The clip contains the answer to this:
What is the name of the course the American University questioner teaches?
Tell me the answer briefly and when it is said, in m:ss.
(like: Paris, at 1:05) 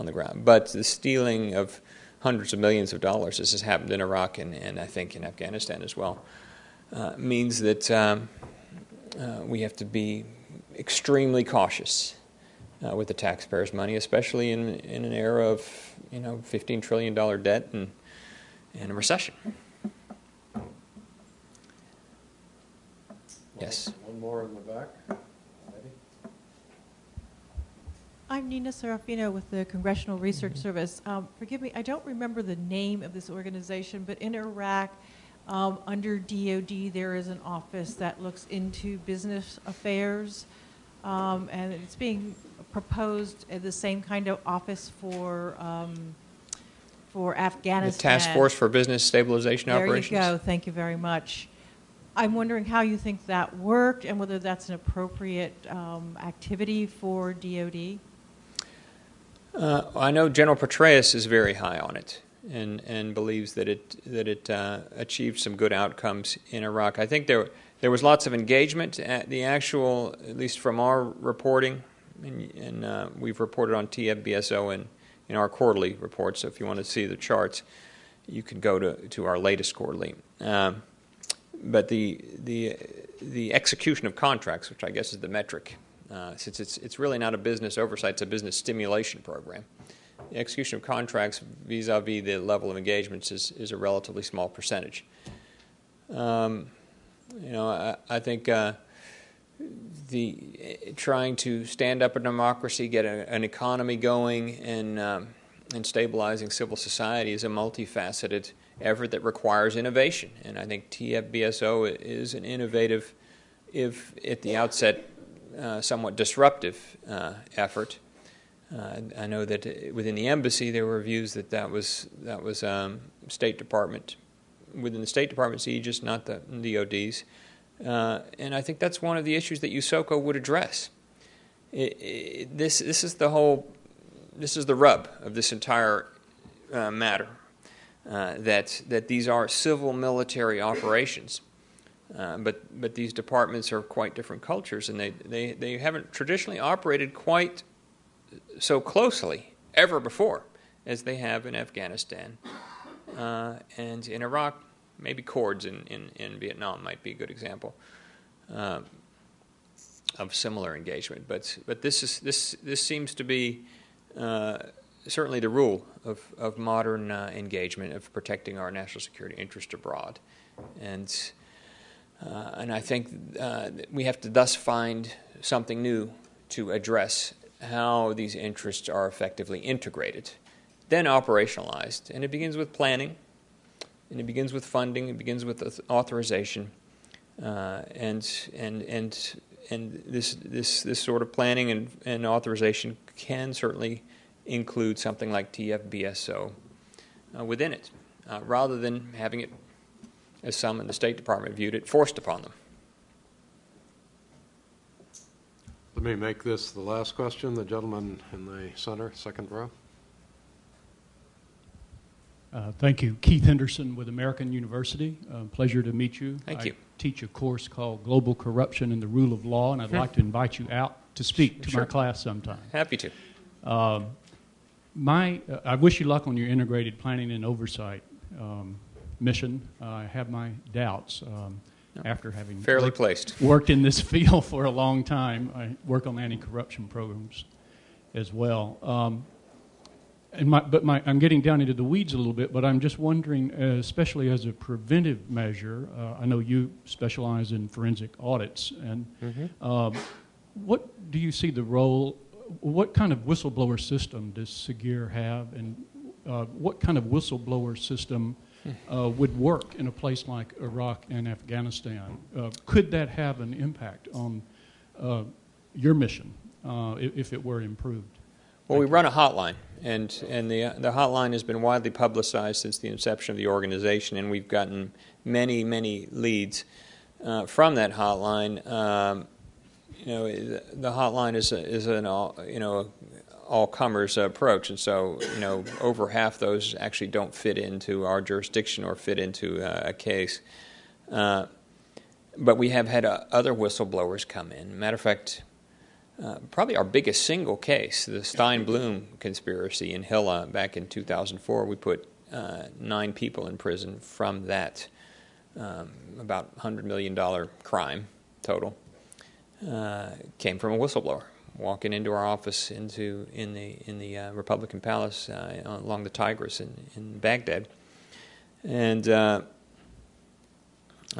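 Global Corruption and the Rule of Law, at 3:38.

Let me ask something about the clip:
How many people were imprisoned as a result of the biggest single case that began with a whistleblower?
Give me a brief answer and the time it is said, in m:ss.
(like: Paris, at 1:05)
9, at 5:02.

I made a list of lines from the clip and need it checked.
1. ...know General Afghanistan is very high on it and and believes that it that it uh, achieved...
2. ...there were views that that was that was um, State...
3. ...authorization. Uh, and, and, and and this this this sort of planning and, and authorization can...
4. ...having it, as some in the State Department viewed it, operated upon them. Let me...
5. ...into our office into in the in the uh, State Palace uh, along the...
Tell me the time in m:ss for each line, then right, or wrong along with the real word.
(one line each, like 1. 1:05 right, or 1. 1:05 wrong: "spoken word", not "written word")
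1. 1:00 wrong: "Petraeus", not "Afghanistan"
2. 2:00 right
3. 3:05 right
4. 3:19 wrong: "forced", not "operated"
5. 5:11 wrong: "Republican", not "State".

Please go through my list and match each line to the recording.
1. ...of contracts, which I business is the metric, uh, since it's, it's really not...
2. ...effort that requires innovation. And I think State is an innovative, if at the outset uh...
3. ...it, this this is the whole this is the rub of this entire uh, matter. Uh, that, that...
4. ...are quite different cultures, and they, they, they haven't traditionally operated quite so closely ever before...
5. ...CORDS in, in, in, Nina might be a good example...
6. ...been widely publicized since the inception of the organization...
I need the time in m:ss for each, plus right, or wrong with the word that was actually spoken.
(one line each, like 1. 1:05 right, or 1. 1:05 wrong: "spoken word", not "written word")
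1. 1:24 wrong: "guess", not "business"
2. 1:48 wrong: "TFBSO", not "State"
3. 2:12 right
4. 2:23 right
5. 2:35 wrong: "Vietnam", not "Nina"
6. 4:31 right.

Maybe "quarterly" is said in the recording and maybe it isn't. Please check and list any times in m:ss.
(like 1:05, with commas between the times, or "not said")
1:15, 1:19.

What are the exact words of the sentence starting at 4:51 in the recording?
Uh, but we have had uh, other whistleblowers come in.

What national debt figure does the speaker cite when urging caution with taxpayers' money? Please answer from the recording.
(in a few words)
15 trillion dollars.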